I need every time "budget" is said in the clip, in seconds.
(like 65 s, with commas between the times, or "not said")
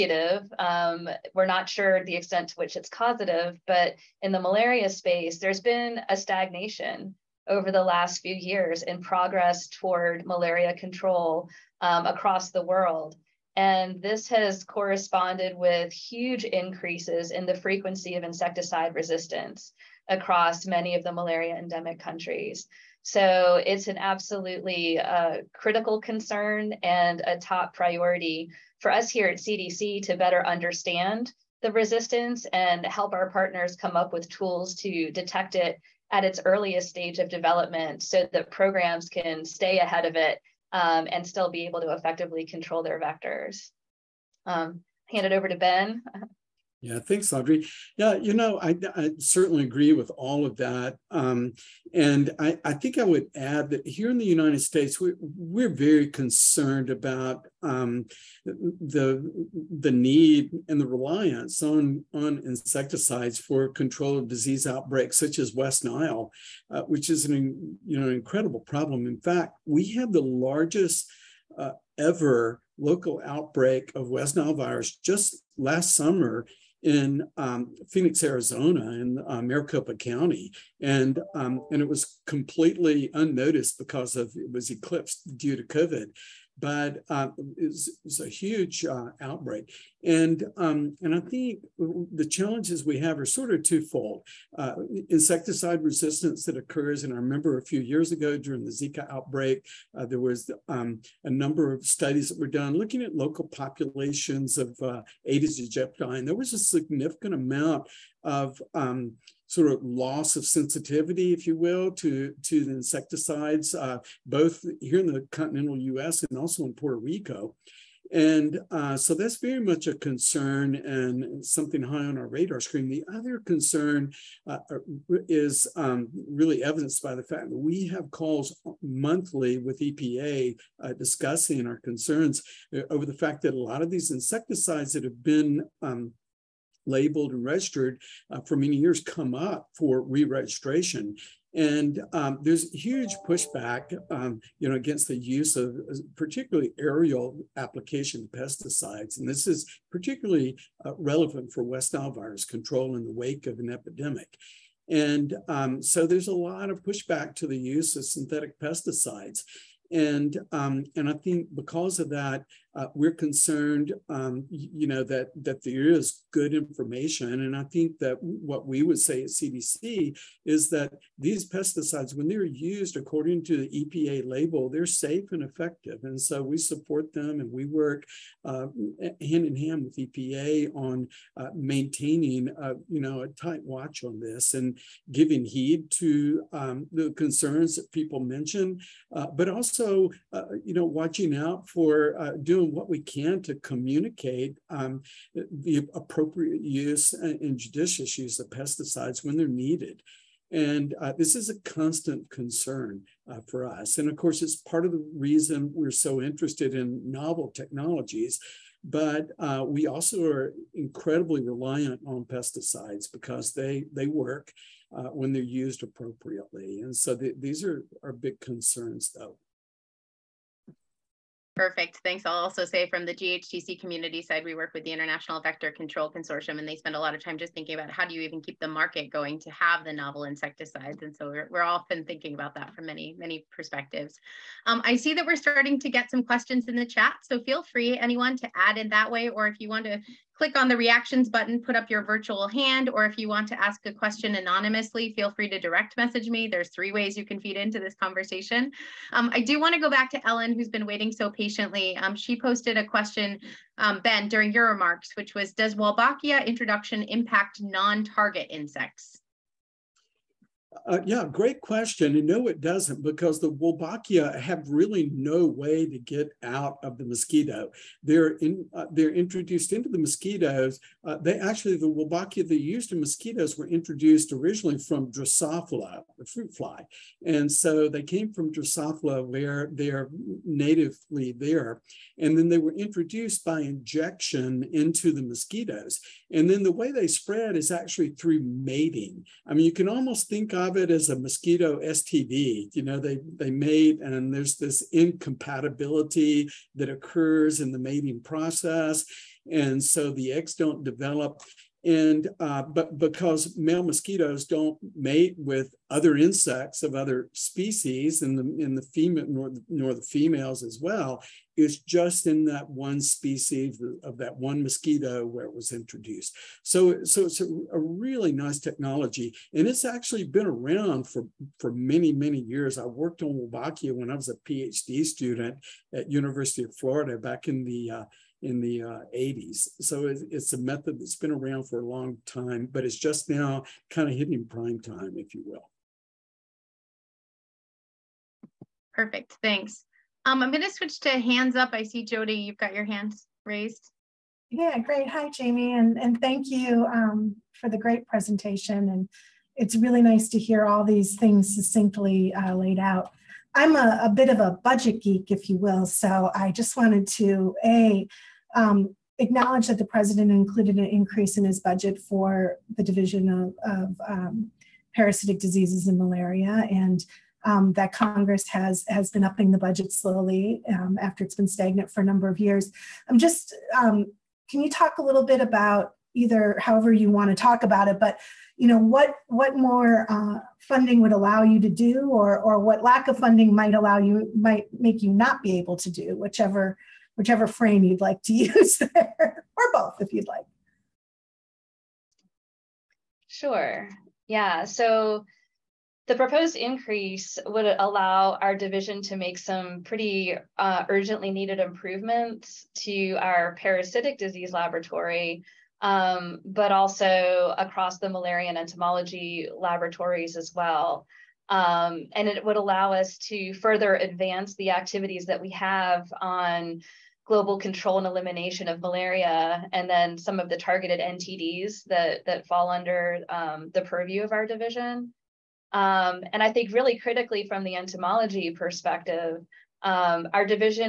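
354 s, 361 s, 369 s.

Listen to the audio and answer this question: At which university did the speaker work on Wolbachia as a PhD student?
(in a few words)
University of Florida.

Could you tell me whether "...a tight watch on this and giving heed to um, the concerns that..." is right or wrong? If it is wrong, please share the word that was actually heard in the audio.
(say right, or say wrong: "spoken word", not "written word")
right.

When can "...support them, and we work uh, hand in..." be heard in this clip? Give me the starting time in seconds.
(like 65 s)
176 s.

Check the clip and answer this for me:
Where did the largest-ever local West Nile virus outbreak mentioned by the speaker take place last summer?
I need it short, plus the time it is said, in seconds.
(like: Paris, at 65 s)
Phoenix, Arizona, at 77 s.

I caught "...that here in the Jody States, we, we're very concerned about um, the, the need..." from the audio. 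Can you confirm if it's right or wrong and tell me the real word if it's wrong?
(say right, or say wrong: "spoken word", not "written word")
wrong: "United", not "Jody".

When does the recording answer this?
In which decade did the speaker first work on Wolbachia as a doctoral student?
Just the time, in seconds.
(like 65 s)
329 s.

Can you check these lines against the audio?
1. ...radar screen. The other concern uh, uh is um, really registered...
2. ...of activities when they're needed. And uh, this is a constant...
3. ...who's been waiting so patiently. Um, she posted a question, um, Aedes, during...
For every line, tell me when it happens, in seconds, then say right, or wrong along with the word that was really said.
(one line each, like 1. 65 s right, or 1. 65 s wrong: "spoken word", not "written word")
1. 122 s wrong: "evidenced", not "registered"
2. 198 s wrong: "pesticides", not "activities"
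3. 250 s wrong: "Ben", not "Aedes".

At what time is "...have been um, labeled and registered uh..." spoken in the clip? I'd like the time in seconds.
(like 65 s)
135 s.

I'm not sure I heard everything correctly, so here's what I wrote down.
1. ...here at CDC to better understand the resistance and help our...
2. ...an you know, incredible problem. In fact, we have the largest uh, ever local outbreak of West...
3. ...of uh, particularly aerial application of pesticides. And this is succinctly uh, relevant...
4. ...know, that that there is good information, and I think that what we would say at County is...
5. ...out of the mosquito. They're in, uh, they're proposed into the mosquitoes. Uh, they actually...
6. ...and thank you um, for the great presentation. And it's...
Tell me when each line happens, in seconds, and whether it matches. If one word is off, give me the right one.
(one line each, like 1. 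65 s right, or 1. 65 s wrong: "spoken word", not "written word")
1. 29 s right
2. 67 s right
3. 145 s wrong: "particularly", not "succinctly"
4. 164 s wrong: "CDC", not "County"
5. 266 s wrong: "introduced", not "proposed"
6. 345 s right.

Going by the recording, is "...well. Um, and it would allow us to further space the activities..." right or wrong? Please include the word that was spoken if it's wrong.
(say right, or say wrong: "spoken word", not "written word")
wrong: "advance", not "space".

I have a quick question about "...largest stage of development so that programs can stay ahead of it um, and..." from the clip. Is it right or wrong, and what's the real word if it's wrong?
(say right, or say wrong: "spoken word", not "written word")
wrong: "earliest", not "largest".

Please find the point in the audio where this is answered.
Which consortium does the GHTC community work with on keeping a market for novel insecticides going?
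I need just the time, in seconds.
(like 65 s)
224 s.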